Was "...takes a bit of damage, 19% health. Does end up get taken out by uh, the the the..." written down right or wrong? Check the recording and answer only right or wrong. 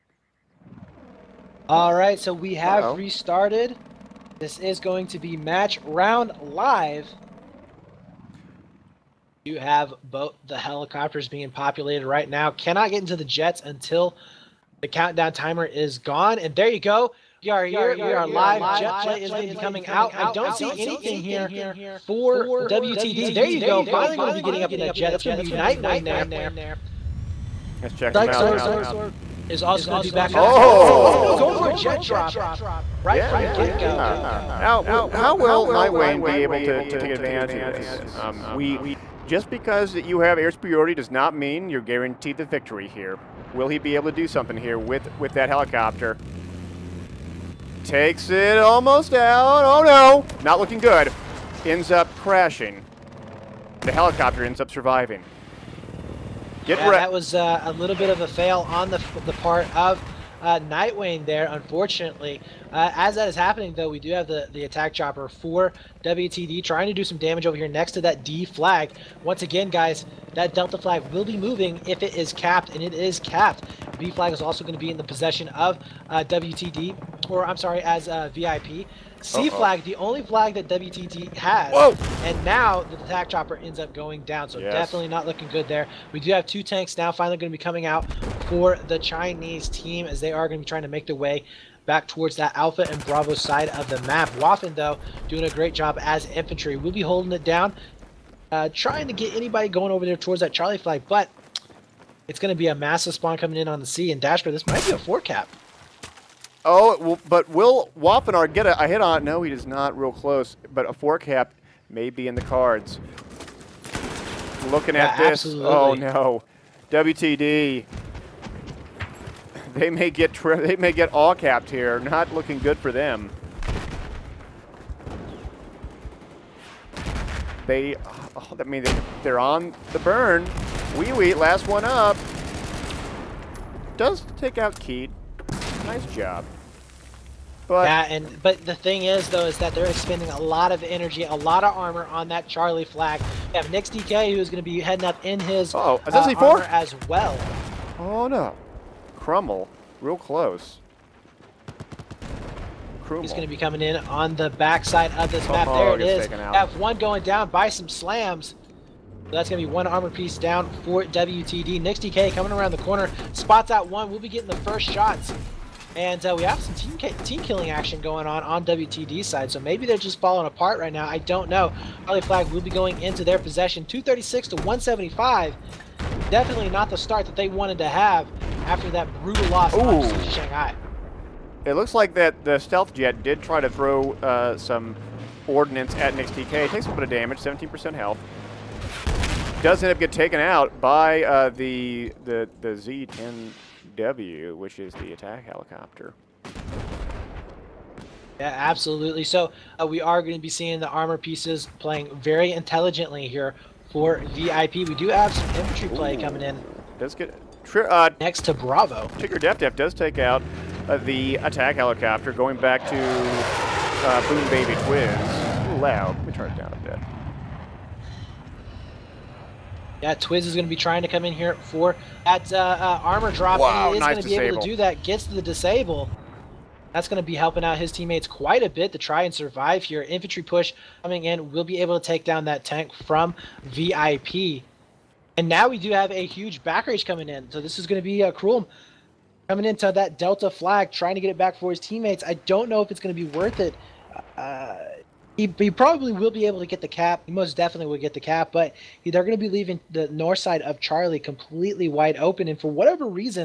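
wrong.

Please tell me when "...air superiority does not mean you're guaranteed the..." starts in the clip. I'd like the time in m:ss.
0:40.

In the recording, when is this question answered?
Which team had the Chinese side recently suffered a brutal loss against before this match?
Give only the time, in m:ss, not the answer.
3:00.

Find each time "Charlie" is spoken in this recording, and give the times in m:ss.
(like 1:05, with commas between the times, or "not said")
1:40, 2:22, 2:52, 4:10.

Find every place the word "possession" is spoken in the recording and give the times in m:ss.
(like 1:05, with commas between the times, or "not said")
1:15, 2:53.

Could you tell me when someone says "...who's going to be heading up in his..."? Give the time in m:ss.
2:24.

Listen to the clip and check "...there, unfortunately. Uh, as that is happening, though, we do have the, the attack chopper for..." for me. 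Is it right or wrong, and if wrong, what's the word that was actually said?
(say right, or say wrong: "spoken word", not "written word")
right.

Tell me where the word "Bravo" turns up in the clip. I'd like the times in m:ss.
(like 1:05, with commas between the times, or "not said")
1:33, 3:28.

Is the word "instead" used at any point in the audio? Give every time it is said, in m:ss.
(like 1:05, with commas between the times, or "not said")
not said.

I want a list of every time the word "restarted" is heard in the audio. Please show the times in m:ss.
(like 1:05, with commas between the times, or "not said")
0:02.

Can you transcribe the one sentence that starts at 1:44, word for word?
And Dashper, this might be a four cap.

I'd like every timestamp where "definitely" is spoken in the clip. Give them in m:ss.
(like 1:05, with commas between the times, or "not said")
1:24, 2:56, 4:07.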